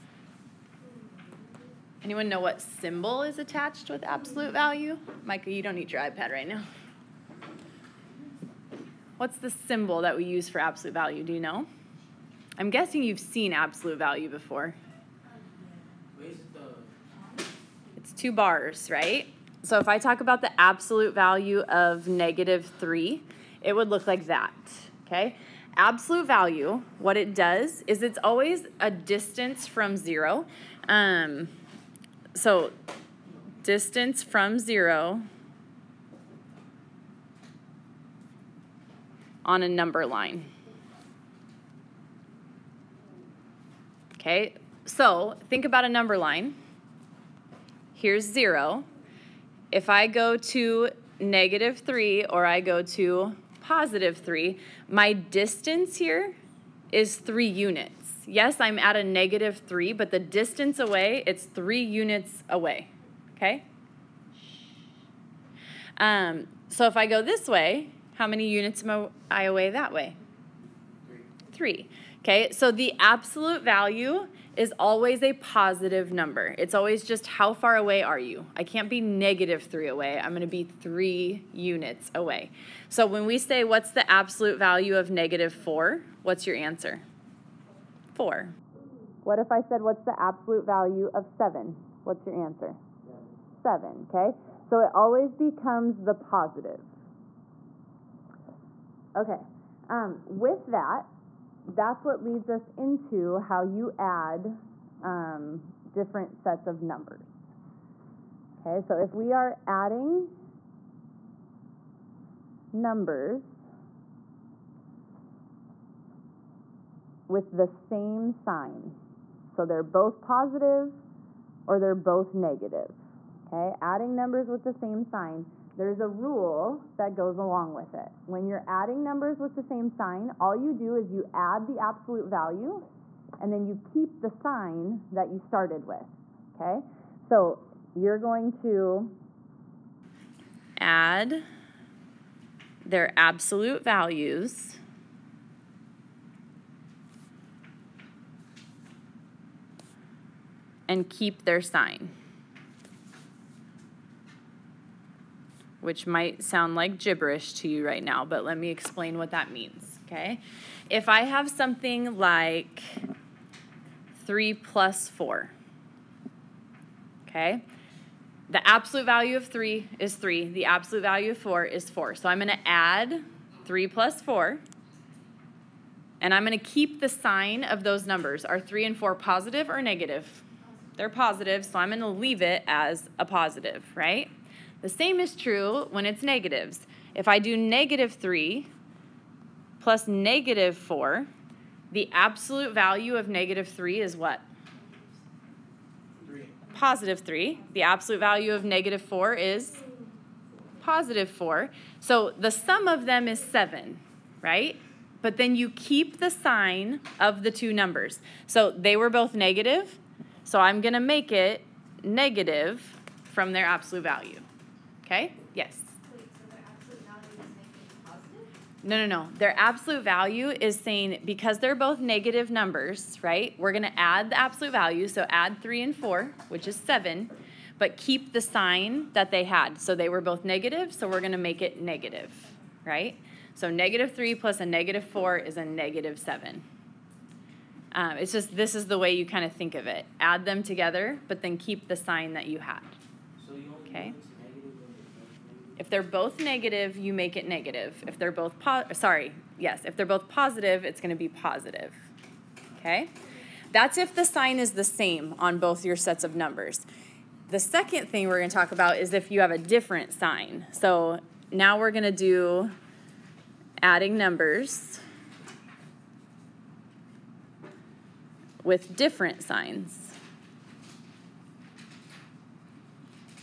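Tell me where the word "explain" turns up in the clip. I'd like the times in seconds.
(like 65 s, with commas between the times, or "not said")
158 s.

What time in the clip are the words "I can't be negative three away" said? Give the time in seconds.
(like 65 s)
78 s.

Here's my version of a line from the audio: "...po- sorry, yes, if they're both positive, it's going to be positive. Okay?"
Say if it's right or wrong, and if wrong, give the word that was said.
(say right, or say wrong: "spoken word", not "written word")
right.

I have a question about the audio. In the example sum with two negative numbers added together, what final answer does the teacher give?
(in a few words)
-7.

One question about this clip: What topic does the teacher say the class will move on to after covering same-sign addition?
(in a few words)
adding numbers with different signs.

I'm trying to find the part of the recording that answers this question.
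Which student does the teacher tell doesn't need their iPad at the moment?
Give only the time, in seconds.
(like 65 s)
5 s.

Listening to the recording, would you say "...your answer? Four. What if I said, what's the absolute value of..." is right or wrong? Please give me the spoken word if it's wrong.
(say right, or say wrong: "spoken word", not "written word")
right.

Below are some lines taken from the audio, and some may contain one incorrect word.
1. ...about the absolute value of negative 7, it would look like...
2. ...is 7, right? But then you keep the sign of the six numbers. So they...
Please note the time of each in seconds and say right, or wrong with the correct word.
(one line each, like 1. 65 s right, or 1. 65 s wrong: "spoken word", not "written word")
1. 20 s wrong: "3", not "7"
2. 203 s wrong: "two", not "six".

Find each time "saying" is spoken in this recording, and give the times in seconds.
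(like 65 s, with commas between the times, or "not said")
220 s.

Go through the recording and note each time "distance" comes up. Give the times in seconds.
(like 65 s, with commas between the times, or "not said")
28 s, 33 s, 55 s, 60 s.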